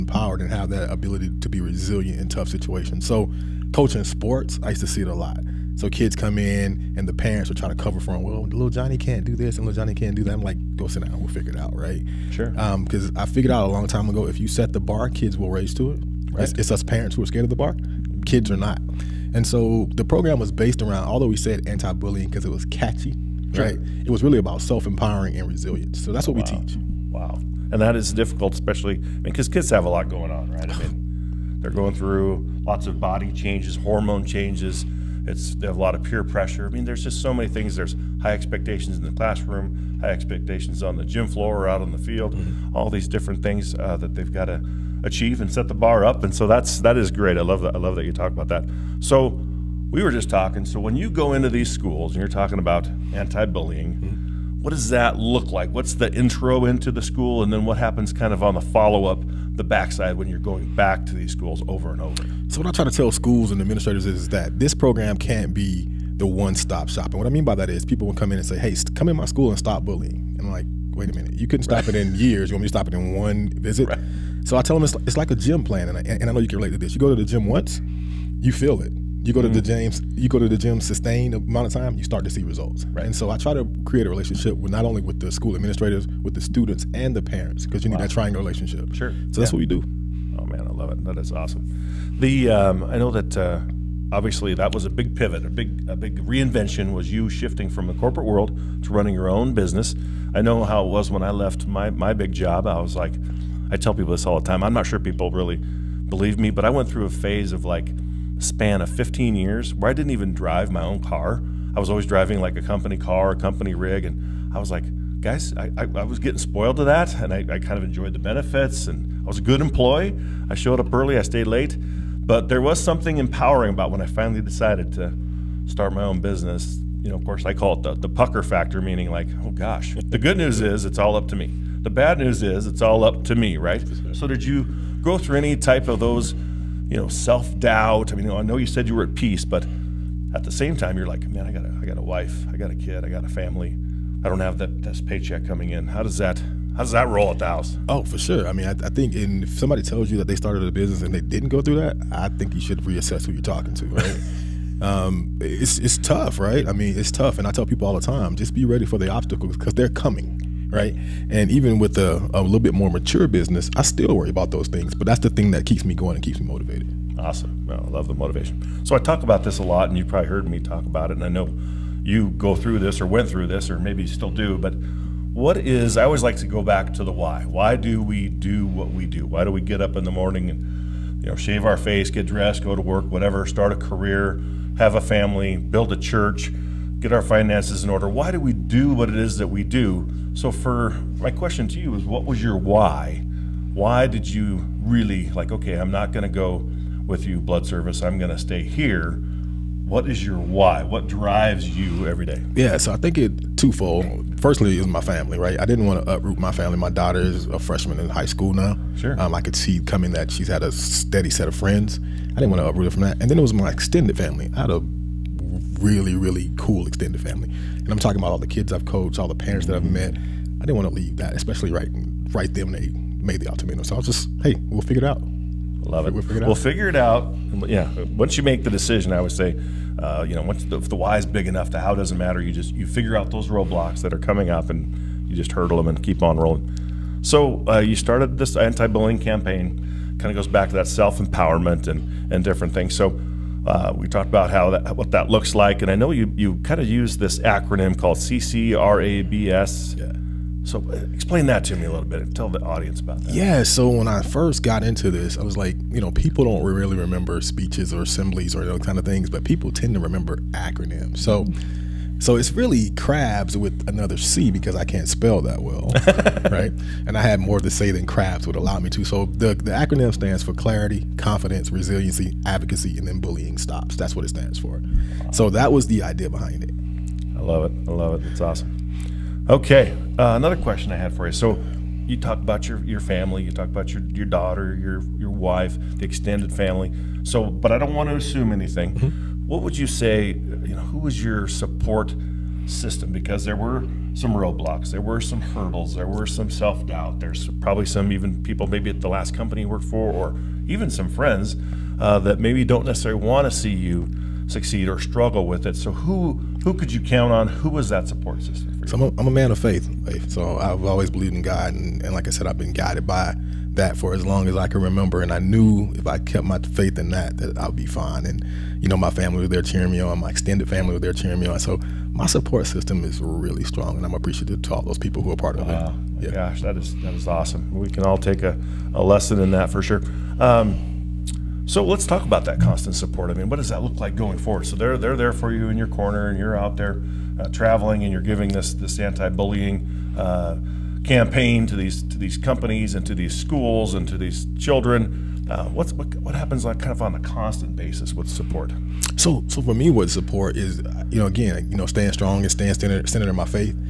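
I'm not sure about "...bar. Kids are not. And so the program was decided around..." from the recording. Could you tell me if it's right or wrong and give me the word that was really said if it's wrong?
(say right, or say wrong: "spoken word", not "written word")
wrong: "based", not "decided".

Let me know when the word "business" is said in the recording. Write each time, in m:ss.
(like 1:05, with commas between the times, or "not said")
1:39, 2:06, 2:30, 2:43.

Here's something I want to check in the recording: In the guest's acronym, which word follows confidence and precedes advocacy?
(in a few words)
resiliency.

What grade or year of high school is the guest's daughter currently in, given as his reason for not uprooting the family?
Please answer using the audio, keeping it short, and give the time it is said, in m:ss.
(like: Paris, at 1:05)
freshman, at 3:27.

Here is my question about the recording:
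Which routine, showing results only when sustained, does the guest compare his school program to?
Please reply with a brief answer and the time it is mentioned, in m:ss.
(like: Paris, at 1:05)
gym plan, at 1:15.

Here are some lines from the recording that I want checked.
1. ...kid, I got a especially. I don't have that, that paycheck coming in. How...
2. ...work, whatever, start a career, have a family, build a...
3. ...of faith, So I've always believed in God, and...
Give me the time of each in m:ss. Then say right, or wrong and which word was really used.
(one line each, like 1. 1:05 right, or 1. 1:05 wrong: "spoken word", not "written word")
1. 2:22 wrong: "family", not "especially"
2. 3:02 right
3. 5:09 right.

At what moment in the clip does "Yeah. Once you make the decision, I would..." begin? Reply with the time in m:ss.
3:47.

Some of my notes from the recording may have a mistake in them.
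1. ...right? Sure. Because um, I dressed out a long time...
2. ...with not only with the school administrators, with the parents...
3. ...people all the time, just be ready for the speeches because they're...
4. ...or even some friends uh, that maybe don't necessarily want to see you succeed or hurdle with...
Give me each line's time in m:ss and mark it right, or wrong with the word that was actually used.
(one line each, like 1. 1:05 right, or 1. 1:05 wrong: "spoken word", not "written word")
1. 0:11 wrong: "figured", not "dressed"
2. 1:24 wrong: "students", not "parents"
3. 2:37 wrong: "obstacles", not "speeches"
4. 5:00 wrong: "struggle", not "hurdle".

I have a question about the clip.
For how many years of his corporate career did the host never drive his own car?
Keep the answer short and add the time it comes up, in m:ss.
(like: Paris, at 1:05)
15, at 1:48.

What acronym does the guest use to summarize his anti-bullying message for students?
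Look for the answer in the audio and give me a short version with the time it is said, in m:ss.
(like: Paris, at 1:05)
CCRABS, at 4:08.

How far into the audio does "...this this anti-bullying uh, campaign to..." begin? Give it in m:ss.
5:38.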